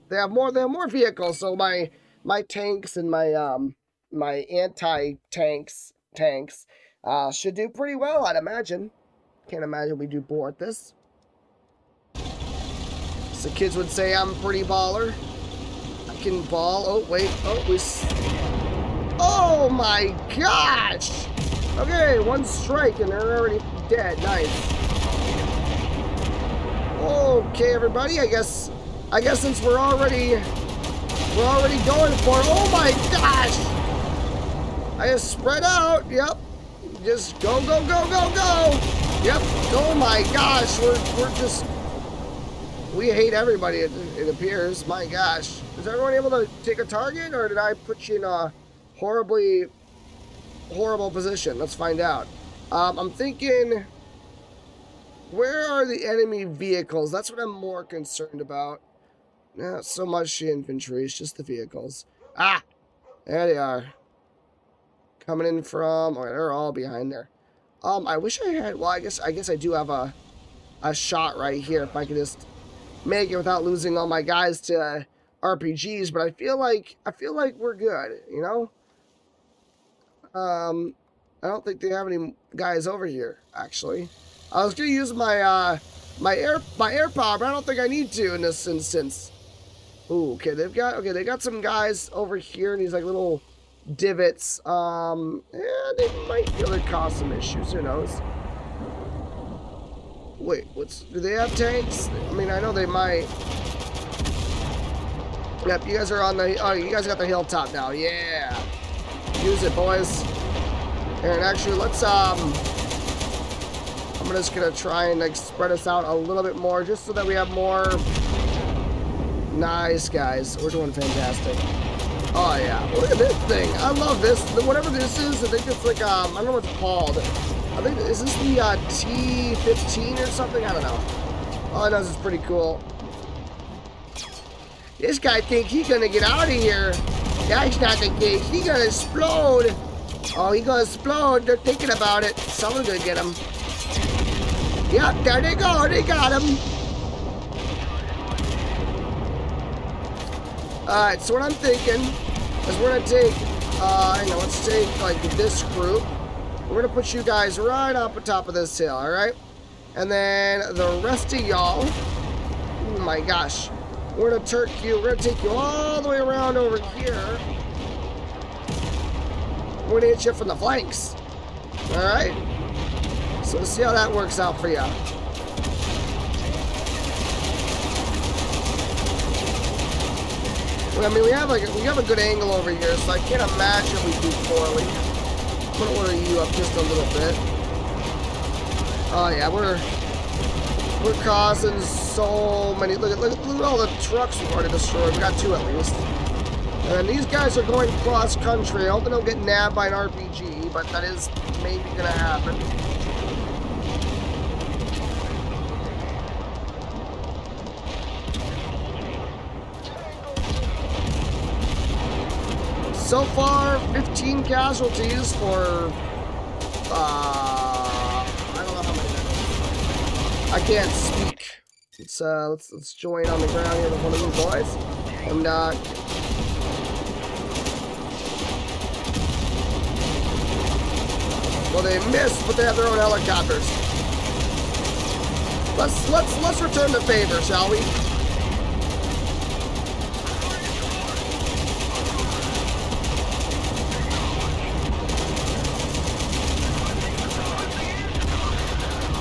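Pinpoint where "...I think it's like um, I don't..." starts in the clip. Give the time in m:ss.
2:05.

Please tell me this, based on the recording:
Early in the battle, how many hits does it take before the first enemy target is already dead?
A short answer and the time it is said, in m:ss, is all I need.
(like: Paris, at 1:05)
1, at 0:22.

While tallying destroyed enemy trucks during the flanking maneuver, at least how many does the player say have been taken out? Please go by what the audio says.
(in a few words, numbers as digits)
2.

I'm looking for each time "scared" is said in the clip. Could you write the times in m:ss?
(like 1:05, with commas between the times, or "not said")
not said.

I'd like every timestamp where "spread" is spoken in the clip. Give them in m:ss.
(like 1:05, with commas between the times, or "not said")
0:35, 1:55.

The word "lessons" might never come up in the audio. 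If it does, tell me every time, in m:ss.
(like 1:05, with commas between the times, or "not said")
not said.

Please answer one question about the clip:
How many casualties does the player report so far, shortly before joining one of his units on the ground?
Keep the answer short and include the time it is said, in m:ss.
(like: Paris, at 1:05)
15, at 3:33.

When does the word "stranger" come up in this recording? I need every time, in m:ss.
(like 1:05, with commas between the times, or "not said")
not said.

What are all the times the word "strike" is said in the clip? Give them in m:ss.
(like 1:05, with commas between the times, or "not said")
0:22.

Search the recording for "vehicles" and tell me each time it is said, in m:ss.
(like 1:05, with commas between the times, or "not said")
0:00, 0:56, 1:01.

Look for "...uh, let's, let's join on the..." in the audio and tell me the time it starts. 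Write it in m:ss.
3:42.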